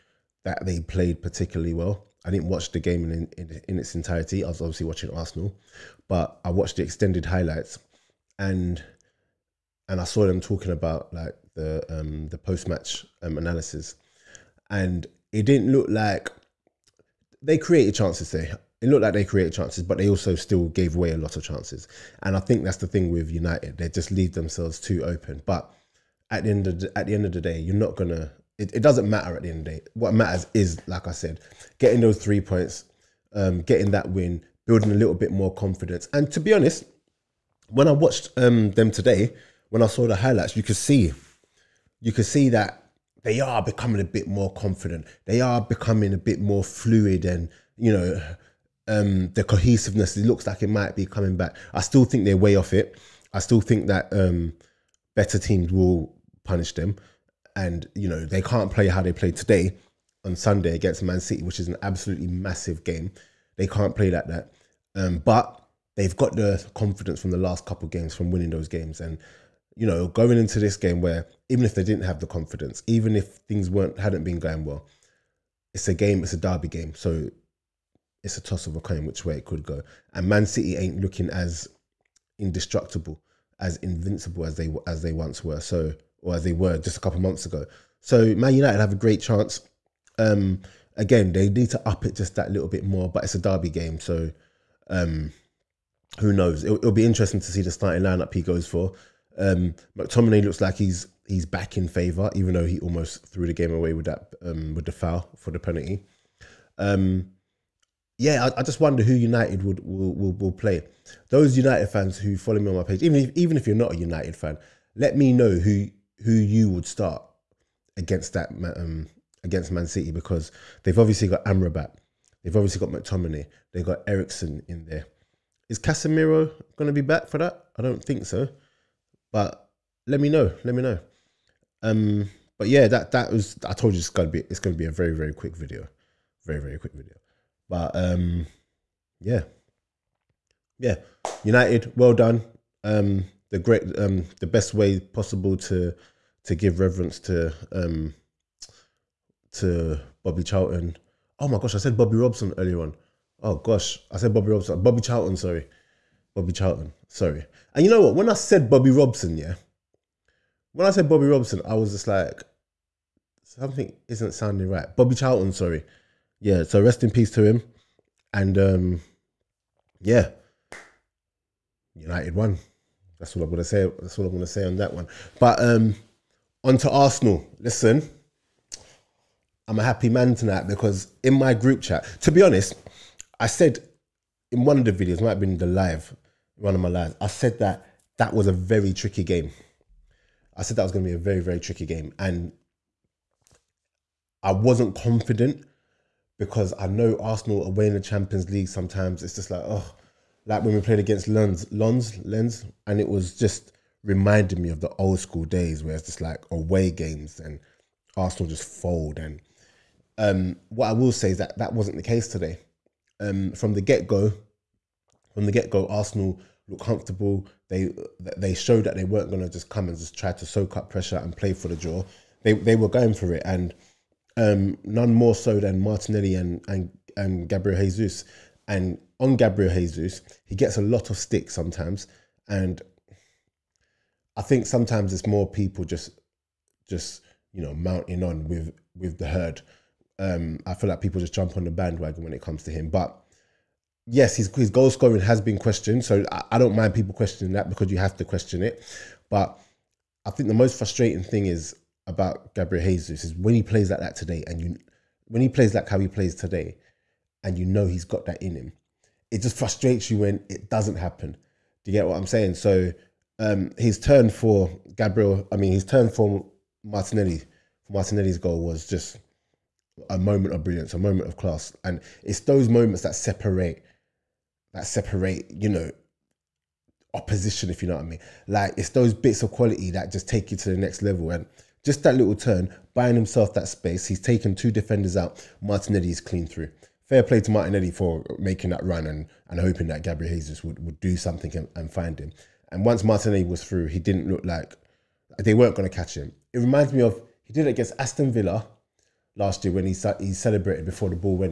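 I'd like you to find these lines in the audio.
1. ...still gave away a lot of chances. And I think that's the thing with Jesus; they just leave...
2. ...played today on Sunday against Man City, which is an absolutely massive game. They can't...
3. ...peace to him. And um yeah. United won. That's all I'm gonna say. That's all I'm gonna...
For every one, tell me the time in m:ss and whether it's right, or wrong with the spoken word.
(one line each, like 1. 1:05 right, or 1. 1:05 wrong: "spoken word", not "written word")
1. 0:20 wrong: "United", not "Jesus"
2. 0:59 right
3. 2:47 right.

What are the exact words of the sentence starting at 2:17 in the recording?
But um, yeah, yeah, United, well done.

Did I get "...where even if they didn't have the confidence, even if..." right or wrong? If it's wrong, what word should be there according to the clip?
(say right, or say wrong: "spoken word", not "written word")
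right.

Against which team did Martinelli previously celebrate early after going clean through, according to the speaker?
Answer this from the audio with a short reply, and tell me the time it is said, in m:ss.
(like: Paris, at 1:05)
Aston Villa, at 4:57.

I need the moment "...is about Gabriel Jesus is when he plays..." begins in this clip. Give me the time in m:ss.
4:11.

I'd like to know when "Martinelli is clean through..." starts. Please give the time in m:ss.
4:45.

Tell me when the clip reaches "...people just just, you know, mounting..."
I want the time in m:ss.
3:55.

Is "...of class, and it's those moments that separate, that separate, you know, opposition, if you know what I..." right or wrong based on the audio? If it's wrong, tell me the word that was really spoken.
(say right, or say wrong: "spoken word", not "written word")
right.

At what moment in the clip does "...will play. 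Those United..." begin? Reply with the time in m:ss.
1:50.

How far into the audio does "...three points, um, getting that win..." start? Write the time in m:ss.
0:32.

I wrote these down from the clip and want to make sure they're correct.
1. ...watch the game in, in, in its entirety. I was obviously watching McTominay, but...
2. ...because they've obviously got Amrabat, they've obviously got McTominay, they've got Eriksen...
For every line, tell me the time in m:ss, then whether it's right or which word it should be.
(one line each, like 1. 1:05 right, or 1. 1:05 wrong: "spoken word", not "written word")
1. 0:02 wrong: "Arsenal", not "McTominay"
2. 2:00 right.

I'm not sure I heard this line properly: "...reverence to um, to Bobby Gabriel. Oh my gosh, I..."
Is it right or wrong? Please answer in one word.
wrong.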